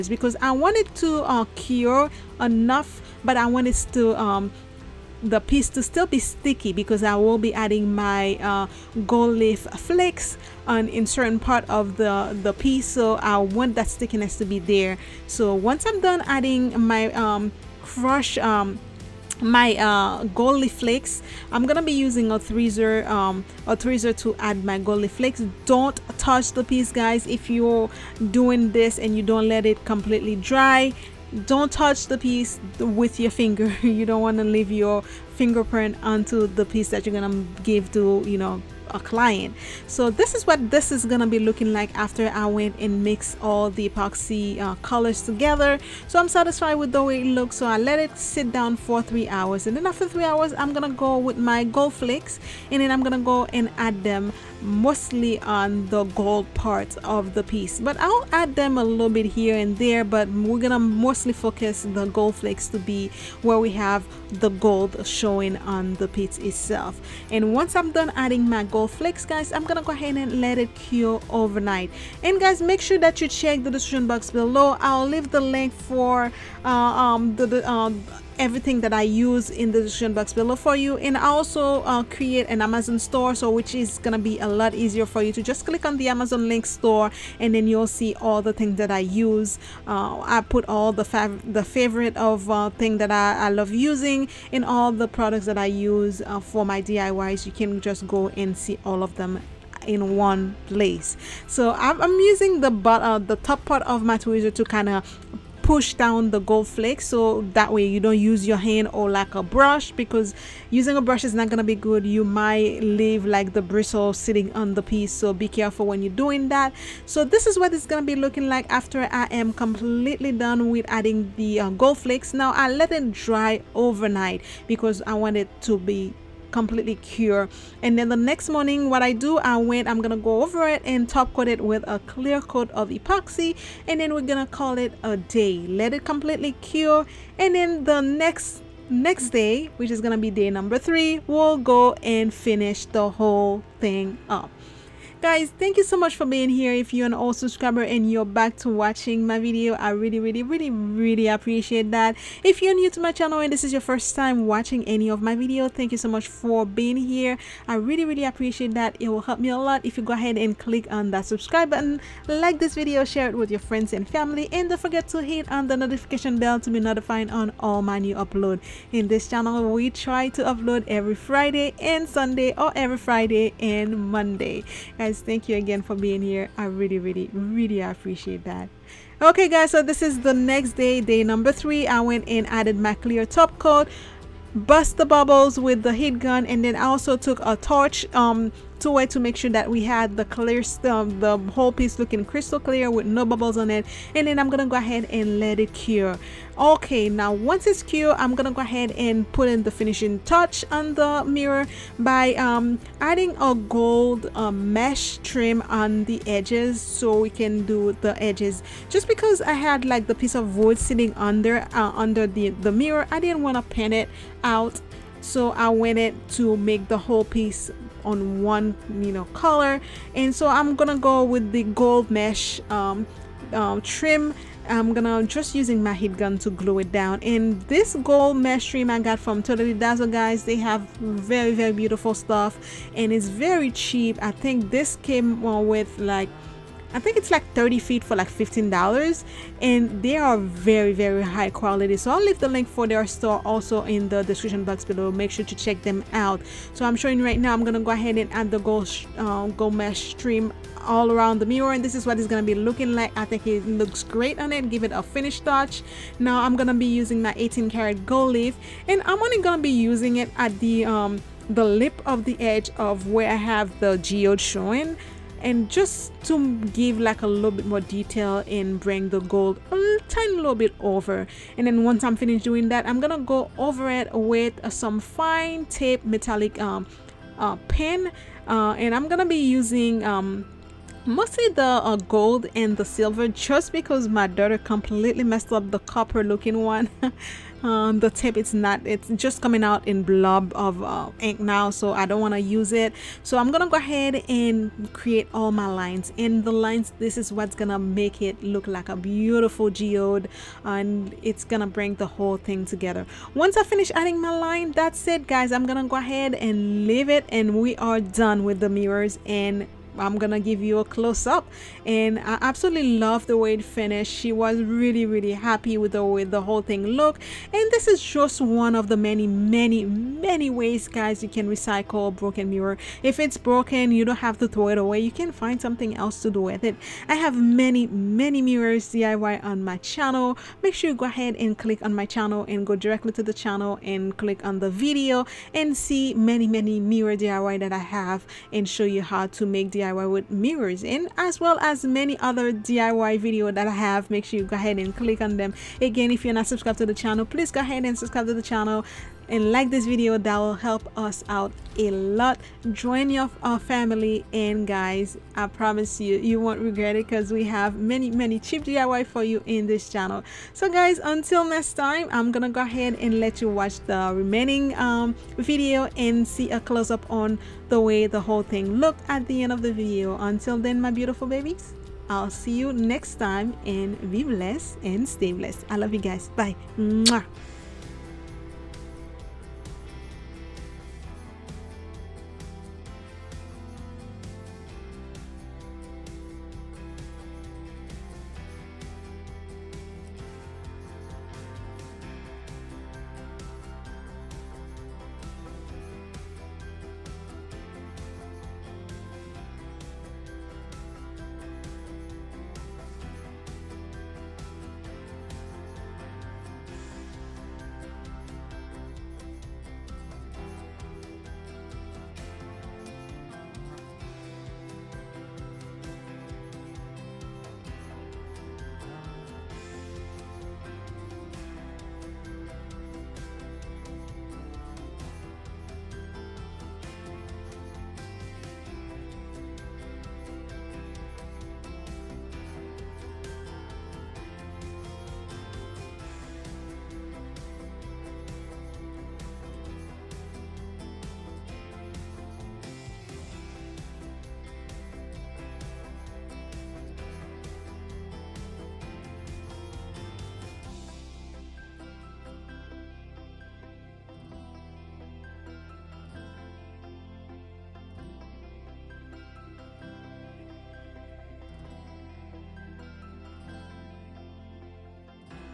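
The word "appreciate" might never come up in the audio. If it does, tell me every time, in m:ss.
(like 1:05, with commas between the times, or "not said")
2:31, 2:38, 2:57.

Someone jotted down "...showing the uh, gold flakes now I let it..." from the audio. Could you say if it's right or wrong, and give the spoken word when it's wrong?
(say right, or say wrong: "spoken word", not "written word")
wrong: "adding", not "showing".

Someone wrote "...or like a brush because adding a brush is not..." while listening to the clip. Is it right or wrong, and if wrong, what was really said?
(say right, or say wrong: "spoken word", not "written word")
wrong: "using", not "adding".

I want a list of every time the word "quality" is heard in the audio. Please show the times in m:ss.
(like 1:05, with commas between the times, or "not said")
4:01.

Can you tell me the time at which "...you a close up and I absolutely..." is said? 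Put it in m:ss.
5:10.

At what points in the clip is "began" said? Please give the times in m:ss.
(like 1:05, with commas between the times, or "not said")
not said.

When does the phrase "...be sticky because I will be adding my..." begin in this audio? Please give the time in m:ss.
0:06.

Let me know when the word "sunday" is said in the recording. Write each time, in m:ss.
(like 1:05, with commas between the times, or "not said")
2:52.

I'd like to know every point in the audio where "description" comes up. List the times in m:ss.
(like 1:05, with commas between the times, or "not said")
1:13, 1:19, 4:04.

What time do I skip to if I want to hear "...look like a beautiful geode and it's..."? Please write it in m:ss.
4:58.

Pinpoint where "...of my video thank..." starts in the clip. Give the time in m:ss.
2:35.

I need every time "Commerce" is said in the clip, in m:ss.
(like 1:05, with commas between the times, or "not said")
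not said.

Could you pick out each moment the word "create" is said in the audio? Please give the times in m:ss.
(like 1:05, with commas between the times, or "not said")
1:22, 4:54.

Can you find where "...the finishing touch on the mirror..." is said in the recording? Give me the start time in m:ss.
3:19.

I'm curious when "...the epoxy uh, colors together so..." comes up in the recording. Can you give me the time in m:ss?
0:43.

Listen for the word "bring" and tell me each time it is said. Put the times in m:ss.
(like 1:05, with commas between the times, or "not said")
4:28, 5:01.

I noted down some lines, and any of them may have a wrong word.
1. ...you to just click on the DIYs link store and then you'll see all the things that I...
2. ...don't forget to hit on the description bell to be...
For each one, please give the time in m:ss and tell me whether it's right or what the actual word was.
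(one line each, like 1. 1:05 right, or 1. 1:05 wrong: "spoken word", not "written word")
1. 1:25 wrong: "Amazon", not "DIYs"
2. 2:44 wrong: "notification", not "description".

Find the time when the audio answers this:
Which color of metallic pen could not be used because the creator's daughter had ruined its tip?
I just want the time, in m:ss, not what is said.
4:45.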